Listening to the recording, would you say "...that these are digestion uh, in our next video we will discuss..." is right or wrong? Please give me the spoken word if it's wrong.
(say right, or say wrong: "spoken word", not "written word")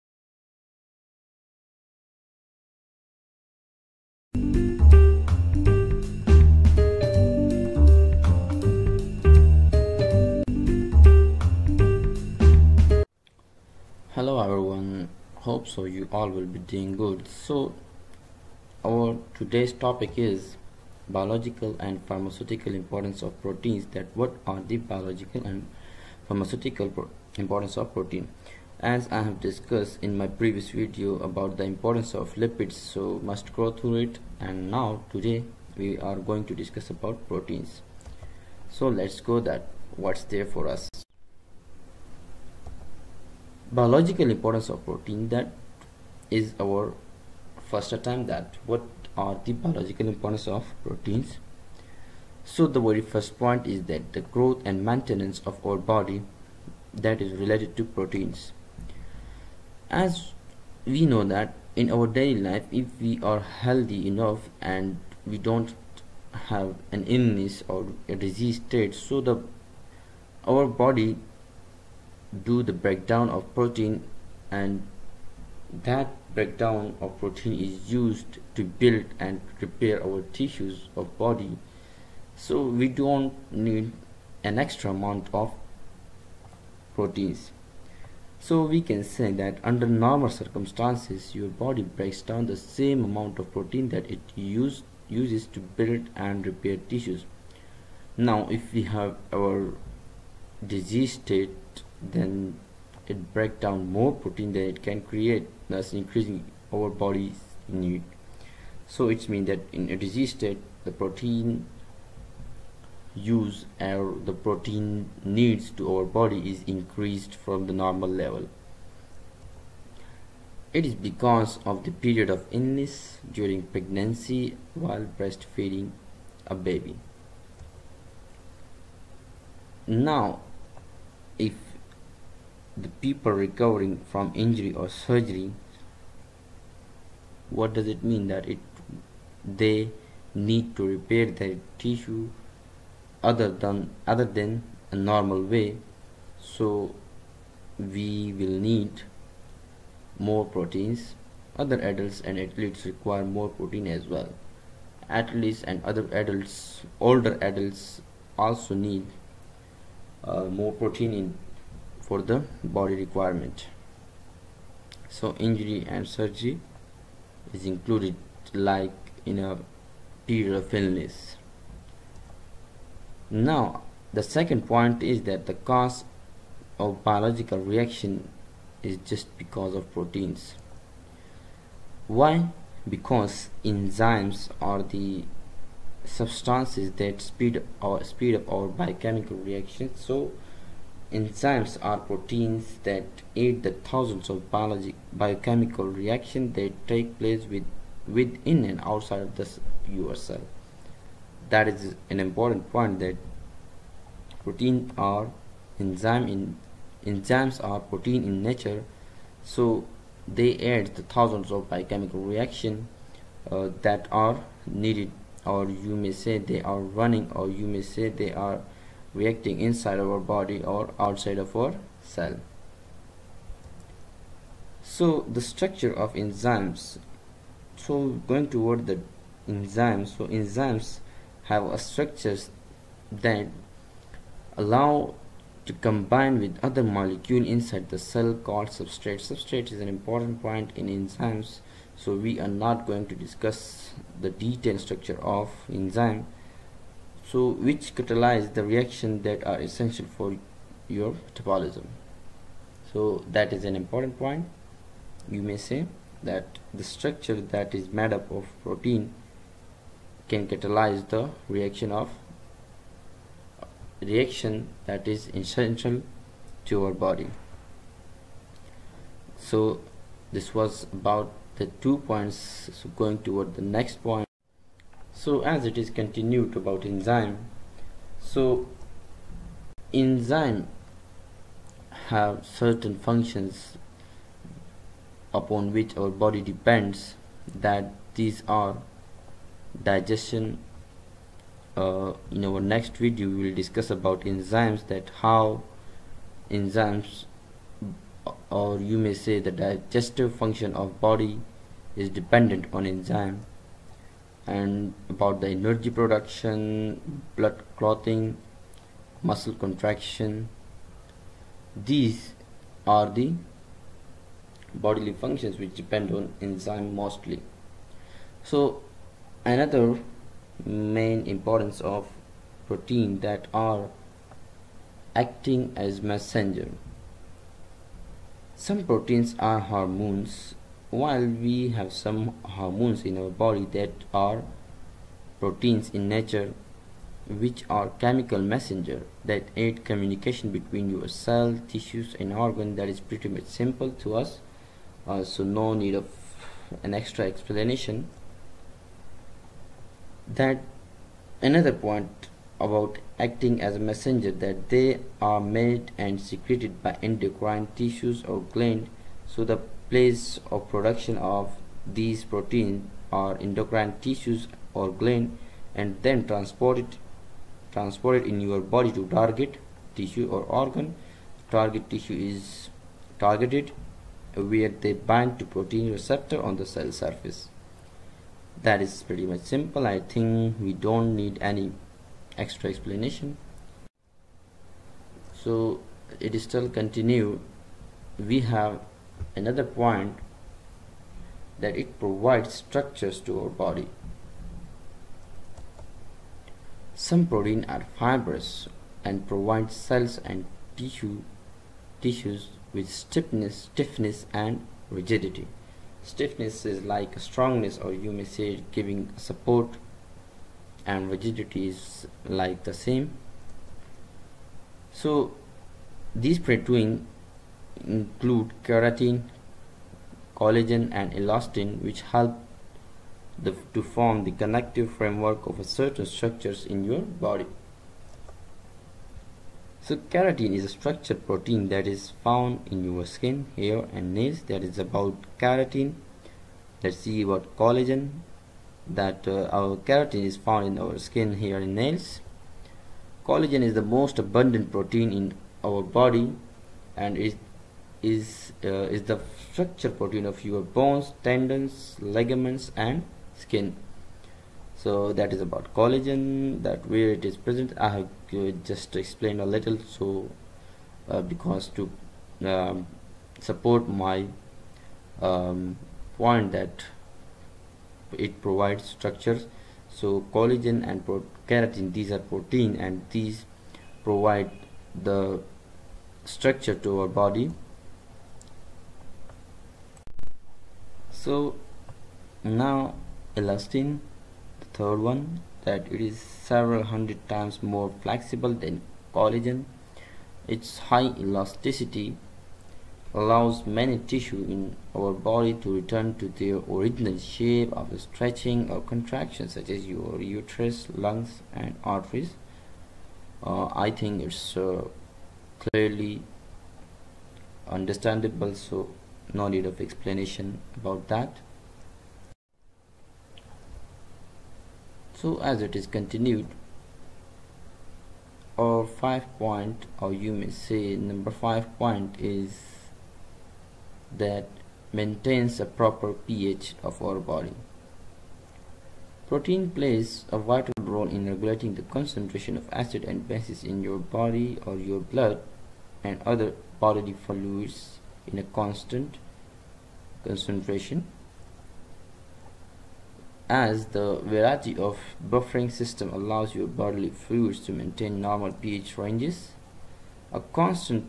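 right.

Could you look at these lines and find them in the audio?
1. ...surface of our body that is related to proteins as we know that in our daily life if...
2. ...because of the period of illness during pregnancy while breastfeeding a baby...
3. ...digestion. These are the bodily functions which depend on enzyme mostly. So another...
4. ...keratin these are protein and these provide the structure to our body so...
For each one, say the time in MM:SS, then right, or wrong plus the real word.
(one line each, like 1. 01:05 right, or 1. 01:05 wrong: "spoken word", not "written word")
1. 00:54 wrong: "maintenance", not "surface"
2. 02:00 right
3. 05:09 wrong: "contraction", not "digestion"
4. 07:51 right.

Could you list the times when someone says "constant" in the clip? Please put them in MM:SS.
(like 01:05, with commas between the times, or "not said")
08:58, 09:10.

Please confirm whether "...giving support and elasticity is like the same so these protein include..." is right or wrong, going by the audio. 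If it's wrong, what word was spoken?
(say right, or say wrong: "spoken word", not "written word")
wrong: "rigidity", not "elasticity".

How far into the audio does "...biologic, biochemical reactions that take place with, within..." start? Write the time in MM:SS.
03:14.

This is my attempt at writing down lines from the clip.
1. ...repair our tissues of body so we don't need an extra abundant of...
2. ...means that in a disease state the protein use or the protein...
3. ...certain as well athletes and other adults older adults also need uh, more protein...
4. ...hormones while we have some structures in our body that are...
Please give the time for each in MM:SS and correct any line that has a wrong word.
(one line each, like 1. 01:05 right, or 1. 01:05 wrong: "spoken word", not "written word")
1. 01:19 wrong: "amount", not "abundant"
2. 01:49 right
3. 02:33 wrong: "protein", not "certain"
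4. 05:29 wrong: "hormones", not "structures".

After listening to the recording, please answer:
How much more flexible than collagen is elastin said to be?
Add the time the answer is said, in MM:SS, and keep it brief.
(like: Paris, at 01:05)
several hundred times, at 08:06.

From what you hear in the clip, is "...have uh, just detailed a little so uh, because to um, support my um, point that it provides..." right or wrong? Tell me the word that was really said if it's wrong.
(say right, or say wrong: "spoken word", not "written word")
wrong: "explained", not "detailed".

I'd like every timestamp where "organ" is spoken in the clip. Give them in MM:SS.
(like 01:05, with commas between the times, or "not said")
05:42, 06:10.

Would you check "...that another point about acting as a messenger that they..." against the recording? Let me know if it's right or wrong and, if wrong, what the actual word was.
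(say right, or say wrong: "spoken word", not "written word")
right.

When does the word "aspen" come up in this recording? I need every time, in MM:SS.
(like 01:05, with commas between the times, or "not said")
not said.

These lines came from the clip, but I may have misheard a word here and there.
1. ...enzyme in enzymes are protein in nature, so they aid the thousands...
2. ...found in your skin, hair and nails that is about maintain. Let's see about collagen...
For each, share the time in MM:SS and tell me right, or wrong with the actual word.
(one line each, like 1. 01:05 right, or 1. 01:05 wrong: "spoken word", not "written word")
1. 03:25 right
2. 07:12 wrong: "keratin", not "maintain".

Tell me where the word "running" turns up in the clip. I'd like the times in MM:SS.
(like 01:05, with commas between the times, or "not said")
03:36.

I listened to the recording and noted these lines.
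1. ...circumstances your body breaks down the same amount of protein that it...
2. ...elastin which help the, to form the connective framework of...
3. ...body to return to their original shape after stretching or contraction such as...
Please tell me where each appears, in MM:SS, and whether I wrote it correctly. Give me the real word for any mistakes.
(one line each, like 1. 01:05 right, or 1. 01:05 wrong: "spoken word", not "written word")
1. 01:30 right
2. 07:01 right
3. 08:15 right.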